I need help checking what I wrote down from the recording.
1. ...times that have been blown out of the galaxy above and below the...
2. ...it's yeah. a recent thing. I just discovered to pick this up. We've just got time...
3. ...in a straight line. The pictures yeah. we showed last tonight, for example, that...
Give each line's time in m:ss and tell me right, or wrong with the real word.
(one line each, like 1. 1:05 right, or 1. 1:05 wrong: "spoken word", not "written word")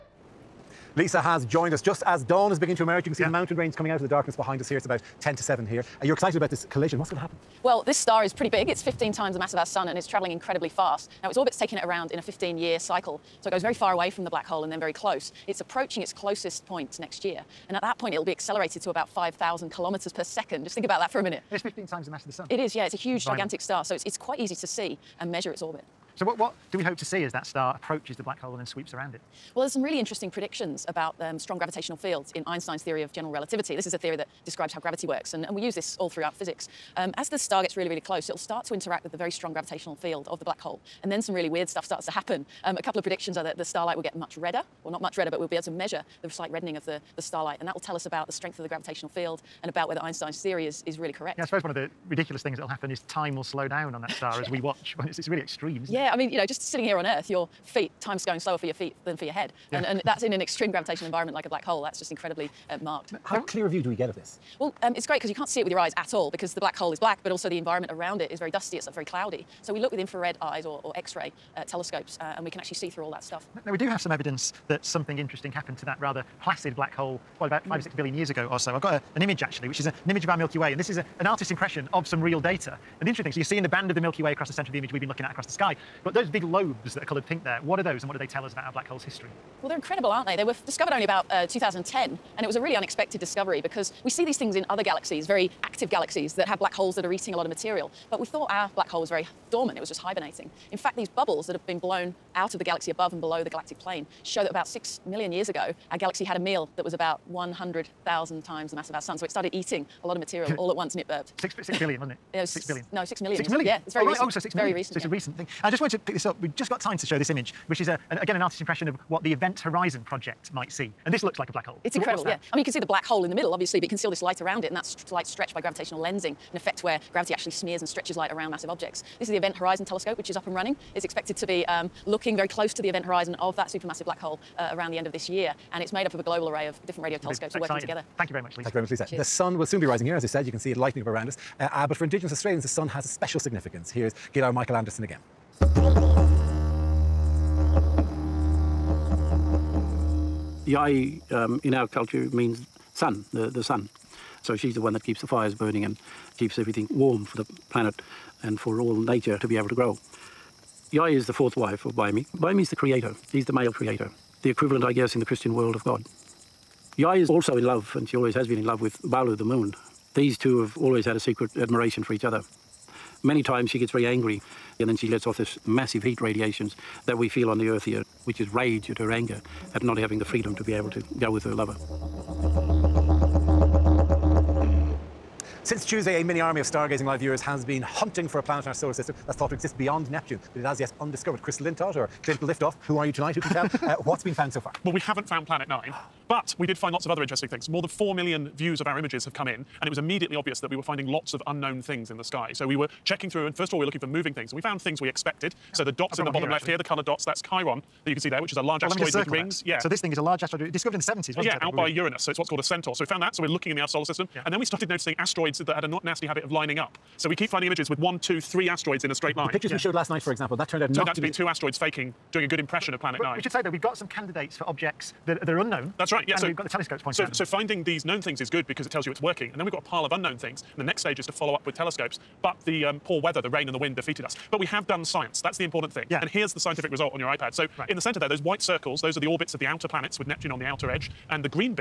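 1. 1:41 wrong: "bubbles", not "times"
2. 1:54 wrong: "wanted", not "discovered"
3. 3:39 wrong: "night", not "tonight".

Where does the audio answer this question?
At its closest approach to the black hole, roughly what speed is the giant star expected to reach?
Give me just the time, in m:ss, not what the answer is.
0:19.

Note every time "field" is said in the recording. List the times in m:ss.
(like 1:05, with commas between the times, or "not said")
0:31, 0:39, 0:49.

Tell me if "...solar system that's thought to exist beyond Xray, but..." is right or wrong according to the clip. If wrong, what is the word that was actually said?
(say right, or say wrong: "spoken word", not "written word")
wrong: "Neptune", not "Xray".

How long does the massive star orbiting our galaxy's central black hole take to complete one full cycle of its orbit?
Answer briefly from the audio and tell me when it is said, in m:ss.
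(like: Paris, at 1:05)
15 years, at 0:12.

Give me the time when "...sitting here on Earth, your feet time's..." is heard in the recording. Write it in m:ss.
0:56.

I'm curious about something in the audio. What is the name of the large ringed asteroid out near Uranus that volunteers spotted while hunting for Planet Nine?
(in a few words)
Chiron.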